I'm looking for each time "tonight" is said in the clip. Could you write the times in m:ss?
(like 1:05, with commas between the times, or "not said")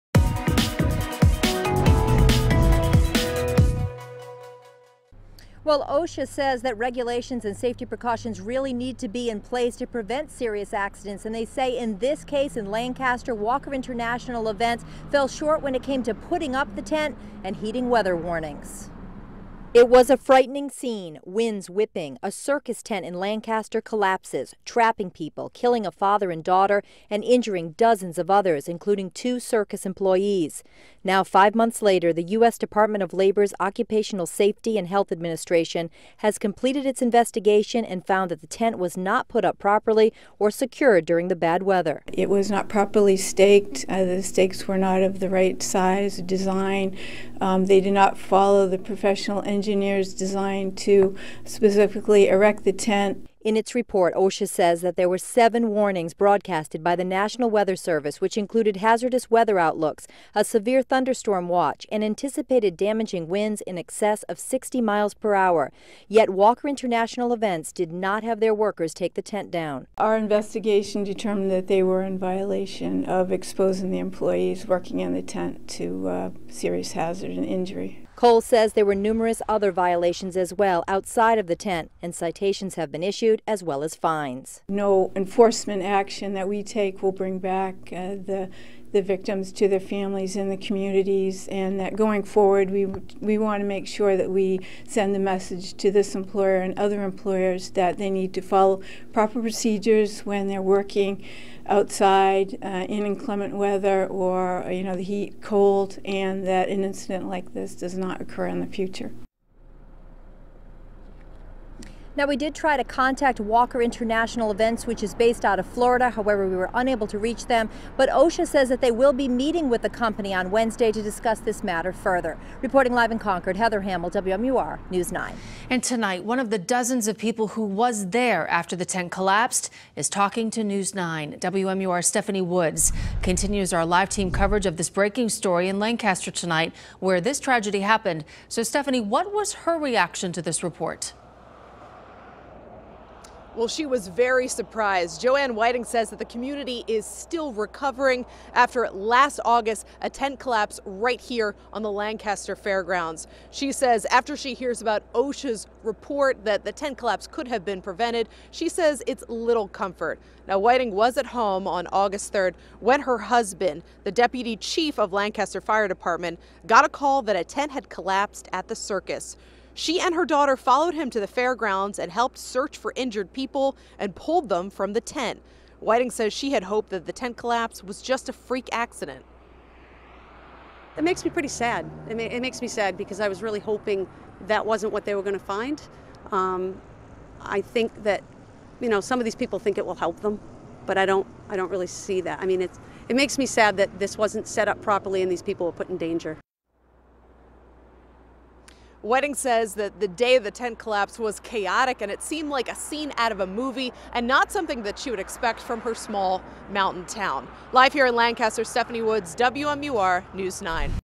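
2:05, 2:16.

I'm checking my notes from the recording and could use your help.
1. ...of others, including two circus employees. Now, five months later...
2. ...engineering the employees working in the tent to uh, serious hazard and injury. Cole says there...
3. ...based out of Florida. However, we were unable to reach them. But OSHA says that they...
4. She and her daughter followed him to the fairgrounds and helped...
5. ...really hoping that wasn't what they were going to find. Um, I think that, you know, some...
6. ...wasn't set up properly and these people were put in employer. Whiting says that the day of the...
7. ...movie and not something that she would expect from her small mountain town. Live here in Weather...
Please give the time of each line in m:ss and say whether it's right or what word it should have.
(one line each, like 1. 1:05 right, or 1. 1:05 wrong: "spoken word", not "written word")
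1. 0:28 right
2. 1:13 wrong: "exposing", not "engineering"
3. 1:55 right
4. 2:49 right
5. 3:03 right
6. 3:14 wrong: "danger", not "employer"
7. 3:23 wrong: "Lancaster", not "Weather".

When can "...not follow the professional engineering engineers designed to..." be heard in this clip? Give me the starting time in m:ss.
0:47.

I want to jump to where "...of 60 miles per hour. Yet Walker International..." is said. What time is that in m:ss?
1:04.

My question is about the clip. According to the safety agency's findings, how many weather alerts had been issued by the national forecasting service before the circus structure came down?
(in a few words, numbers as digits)
7.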